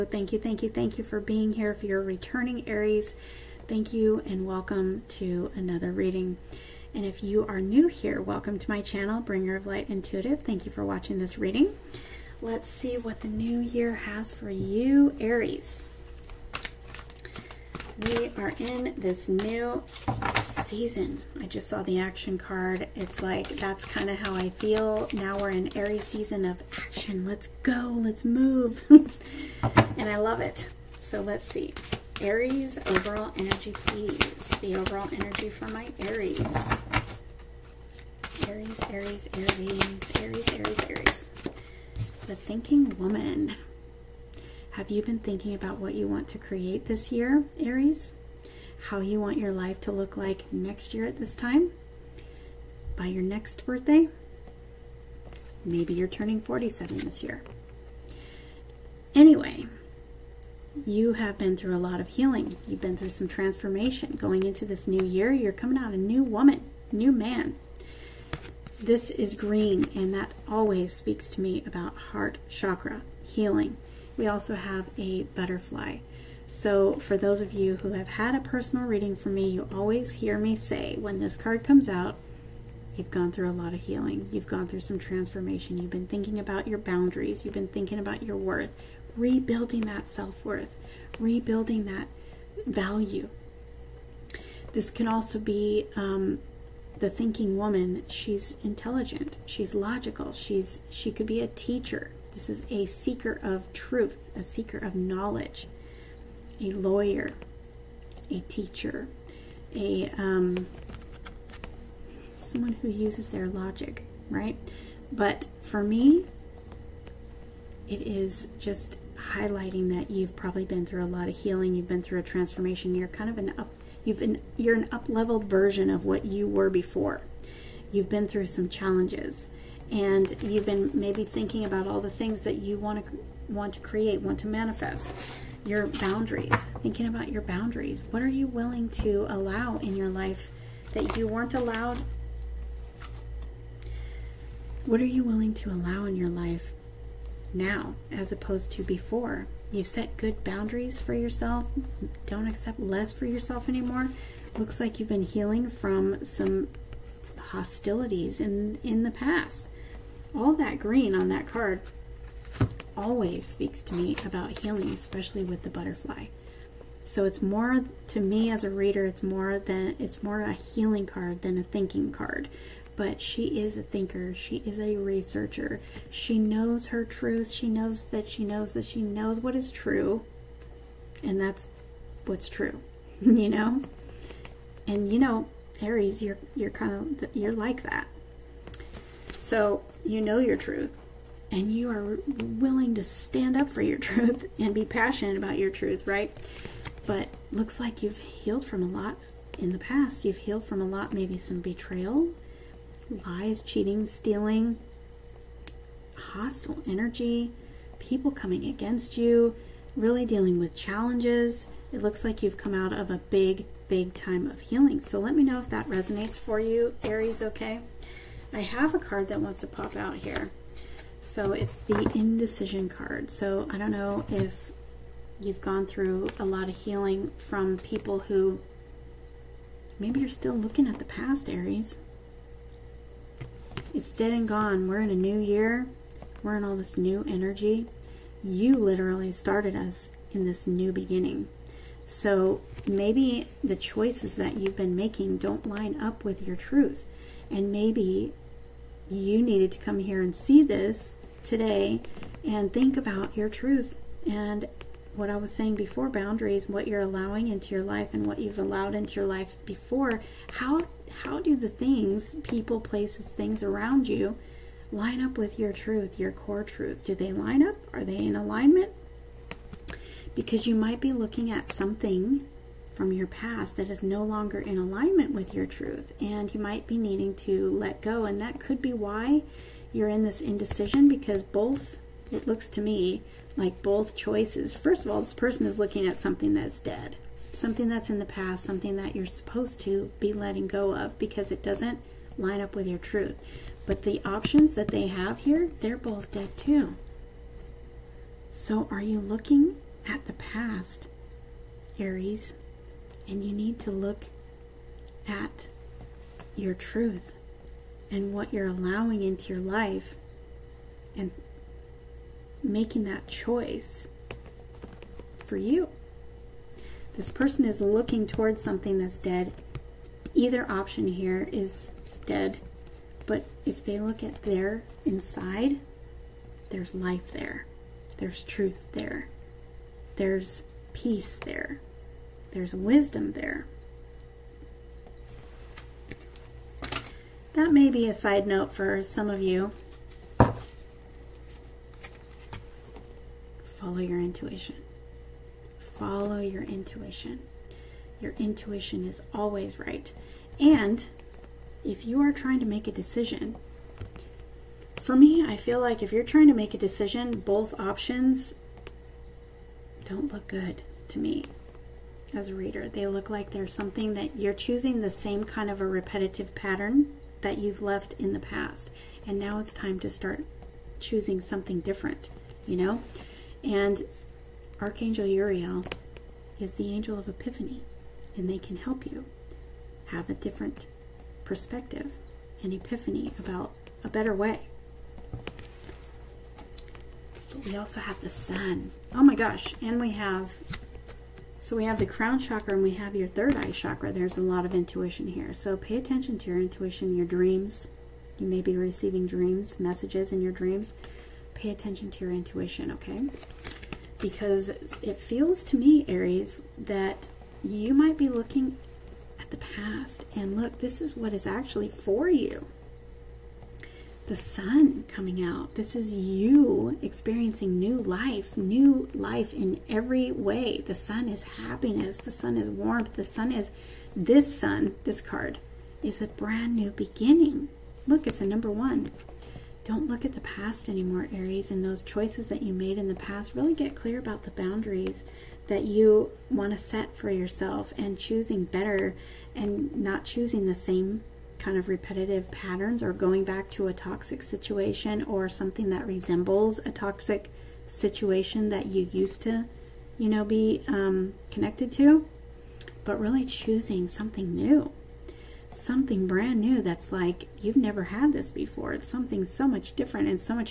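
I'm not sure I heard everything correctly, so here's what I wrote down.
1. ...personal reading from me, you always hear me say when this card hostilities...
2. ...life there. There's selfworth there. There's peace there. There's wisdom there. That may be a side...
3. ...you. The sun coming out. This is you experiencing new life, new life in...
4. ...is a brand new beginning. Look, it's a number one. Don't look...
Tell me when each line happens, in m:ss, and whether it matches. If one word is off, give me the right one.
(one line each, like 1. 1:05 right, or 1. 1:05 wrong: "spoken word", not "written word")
1. 1:18 wrong: "comes", not "hostilities"
2. 5:26 wrong: "truth", not "selfworth"
3. 6:52 right
4. 7:06 right.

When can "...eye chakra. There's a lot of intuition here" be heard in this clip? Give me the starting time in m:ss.
6:33.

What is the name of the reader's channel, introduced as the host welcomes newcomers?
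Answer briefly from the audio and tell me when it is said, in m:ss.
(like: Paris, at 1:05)
Bringer of Light Intuitive, at 0:09.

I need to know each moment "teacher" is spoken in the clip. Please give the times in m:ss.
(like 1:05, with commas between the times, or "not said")
1:41, 1:48.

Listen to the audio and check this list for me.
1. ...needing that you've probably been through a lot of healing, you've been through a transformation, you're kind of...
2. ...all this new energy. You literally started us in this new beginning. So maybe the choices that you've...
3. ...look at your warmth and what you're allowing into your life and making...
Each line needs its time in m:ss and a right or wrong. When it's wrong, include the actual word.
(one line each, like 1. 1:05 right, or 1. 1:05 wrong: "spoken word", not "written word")
1. 1:59 wrong: "highlighting", not "needing"
2. 3:56 right
3. 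5:03 wrong: "truth", not "warmth".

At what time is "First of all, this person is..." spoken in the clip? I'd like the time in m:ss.
4:44.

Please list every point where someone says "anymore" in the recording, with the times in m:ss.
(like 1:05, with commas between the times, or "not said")
2:33, 7:10.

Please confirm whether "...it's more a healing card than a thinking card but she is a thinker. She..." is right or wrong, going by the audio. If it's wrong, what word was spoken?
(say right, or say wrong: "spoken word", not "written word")
right.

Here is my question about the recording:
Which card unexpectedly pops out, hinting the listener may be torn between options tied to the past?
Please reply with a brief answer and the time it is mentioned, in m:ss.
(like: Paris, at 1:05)
The indecision card, at 3:41.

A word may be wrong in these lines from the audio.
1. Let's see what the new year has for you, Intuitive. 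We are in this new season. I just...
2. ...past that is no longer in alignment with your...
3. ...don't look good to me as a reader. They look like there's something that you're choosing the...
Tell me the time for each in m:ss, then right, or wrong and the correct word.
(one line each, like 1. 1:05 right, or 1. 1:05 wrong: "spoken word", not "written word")
1. 0:12 wrong: "Aries", not "Intuitive"
2. 4:33 right
3. 6:00 right.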